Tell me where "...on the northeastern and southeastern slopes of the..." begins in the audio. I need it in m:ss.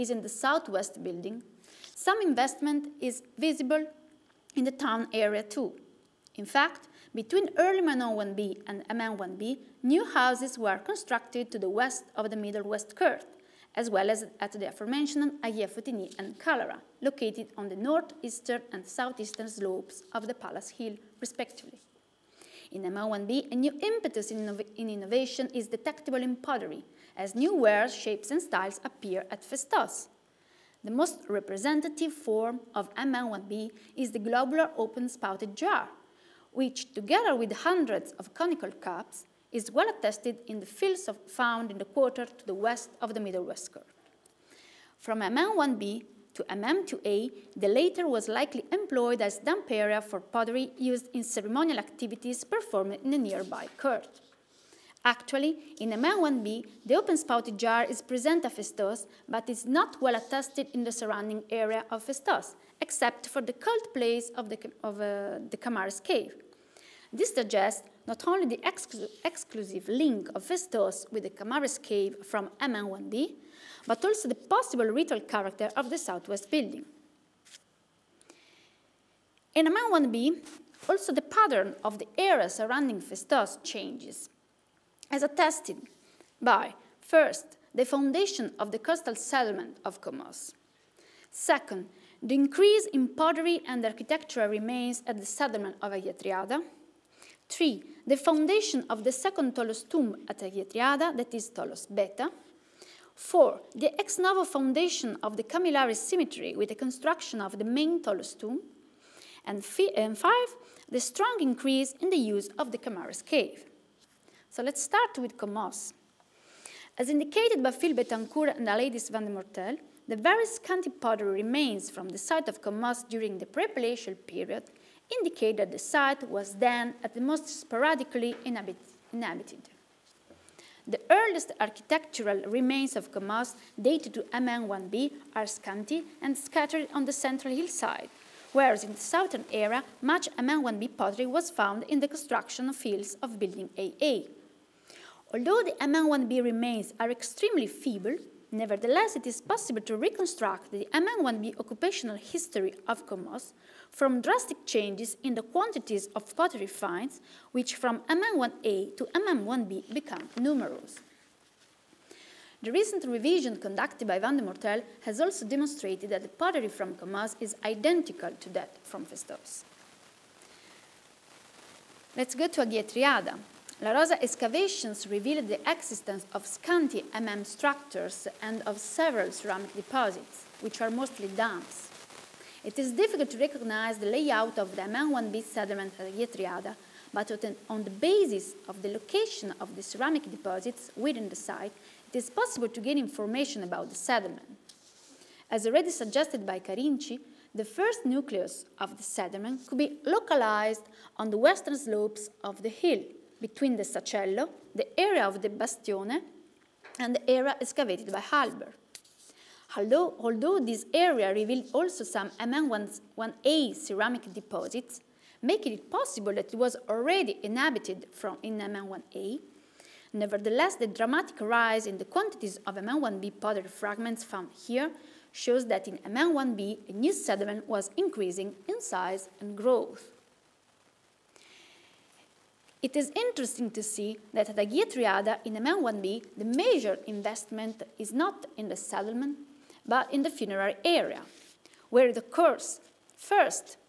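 0:17.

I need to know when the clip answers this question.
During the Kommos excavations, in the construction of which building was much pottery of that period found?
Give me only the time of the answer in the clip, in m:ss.
2:23.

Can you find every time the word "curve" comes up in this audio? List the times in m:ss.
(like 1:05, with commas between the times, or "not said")
0:12, 0:43.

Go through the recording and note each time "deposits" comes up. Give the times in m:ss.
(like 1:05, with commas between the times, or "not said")
2:59, 3:10, 3:34.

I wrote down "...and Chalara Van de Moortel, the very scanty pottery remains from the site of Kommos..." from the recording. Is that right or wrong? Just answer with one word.
wrong.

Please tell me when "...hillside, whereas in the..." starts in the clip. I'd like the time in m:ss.
2:17.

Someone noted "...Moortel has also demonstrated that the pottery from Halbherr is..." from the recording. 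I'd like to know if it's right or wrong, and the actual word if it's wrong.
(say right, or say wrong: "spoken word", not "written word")
wrong: "Kommos", not "Halbherr".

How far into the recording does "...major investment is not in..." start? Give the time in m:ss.
3:56.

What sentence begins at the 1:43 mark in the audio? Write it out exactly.
Four, the ex novo foundation of the Kamilari cemetery with the construction of the main tholos tomb.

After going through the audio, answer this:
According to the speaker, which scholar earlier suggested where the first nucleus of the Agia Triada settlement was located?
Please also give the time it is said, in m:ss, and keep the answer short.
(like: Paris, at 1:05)
Carinci, at 3:16.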